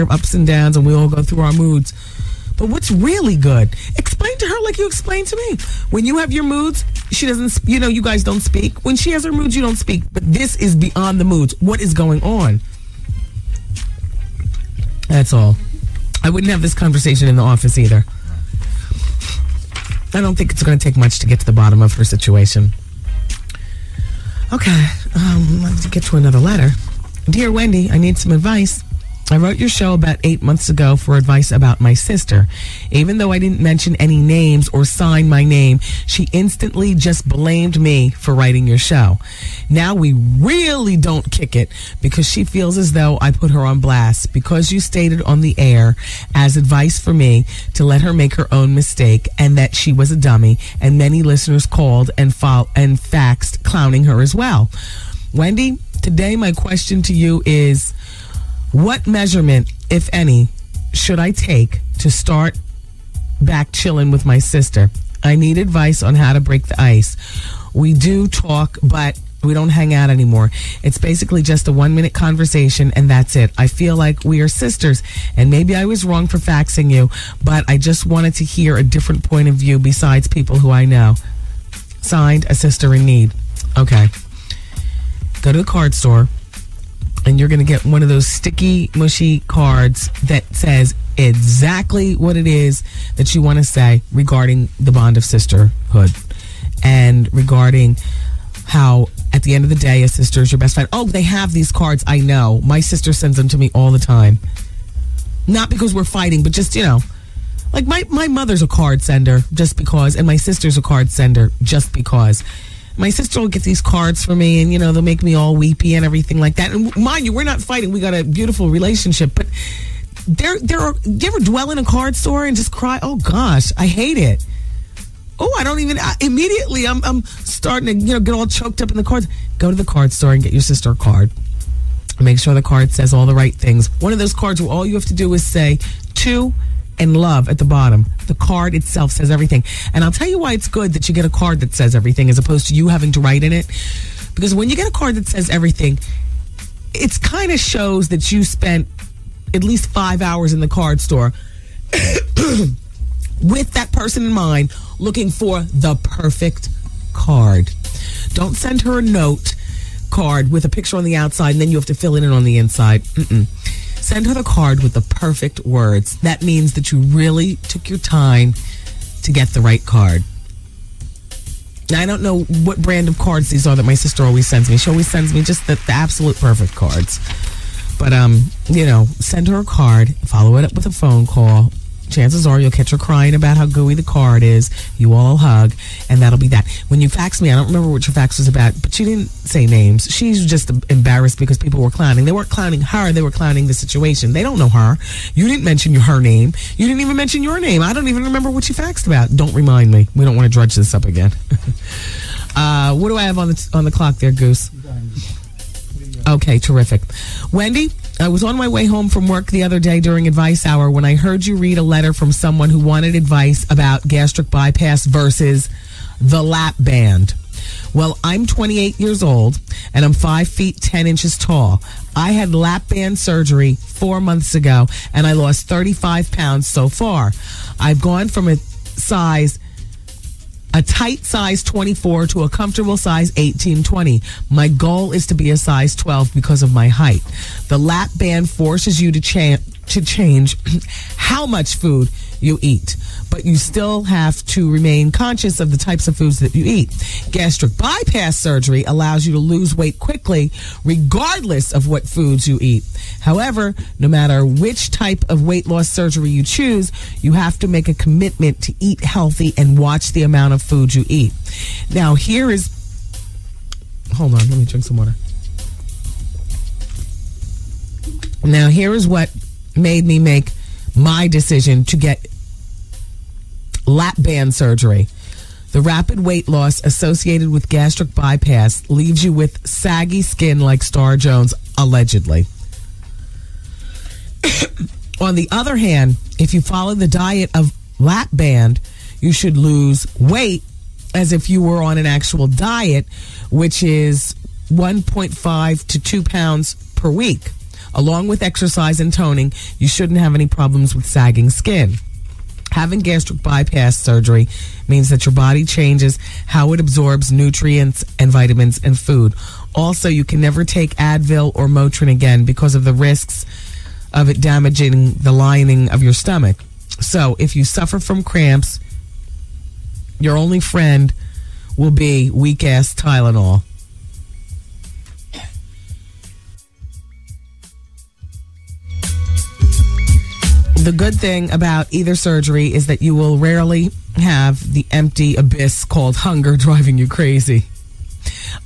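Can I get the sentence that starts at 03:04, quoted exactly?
You all hug, and that'll be that.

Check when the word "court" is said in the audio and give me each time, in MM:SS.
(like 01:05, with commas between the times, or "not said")
not said.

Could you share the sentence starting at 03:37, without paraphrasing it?
Well, I'm 28 years old and I'm 5 feet 10 inches tall.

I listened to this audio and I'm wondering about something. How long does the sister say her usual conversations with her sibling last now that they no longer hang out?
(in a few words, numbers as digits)
1 minute.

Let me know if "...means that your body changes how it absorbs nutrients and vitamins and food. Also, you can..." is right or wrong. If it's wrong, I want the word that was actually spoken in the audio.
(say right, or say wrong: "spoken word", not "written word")
right.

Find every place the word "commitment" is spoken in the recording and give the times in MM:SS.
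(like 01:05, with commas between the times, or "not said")
04:17.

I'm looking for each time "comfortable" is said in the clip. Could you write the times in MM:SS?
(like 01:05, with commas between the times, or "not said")
03:52.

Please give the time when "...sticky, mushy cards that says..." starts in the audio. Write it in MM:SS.
01:28.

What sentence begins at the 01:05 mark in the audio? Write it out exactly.
I need advice on how to break the ice.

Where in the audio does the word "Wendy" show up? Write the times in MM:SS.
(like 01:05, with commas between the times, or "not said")
00:27, 00:55, 03:27.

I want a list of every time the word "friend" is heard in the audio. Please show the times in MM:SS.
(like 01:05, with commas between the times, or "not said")
01:40, 05:20.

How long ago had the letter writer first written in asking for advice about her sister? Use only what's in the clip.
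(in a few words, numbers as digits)
8 months ago.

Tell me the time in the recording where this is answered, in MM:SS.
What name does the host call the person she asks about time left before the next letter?
03:24.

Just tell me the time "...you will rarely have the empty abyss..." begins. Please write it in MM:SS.
05:33.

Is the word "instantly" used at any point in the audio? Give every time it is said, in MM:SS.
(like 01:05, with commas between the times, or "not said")
00:36.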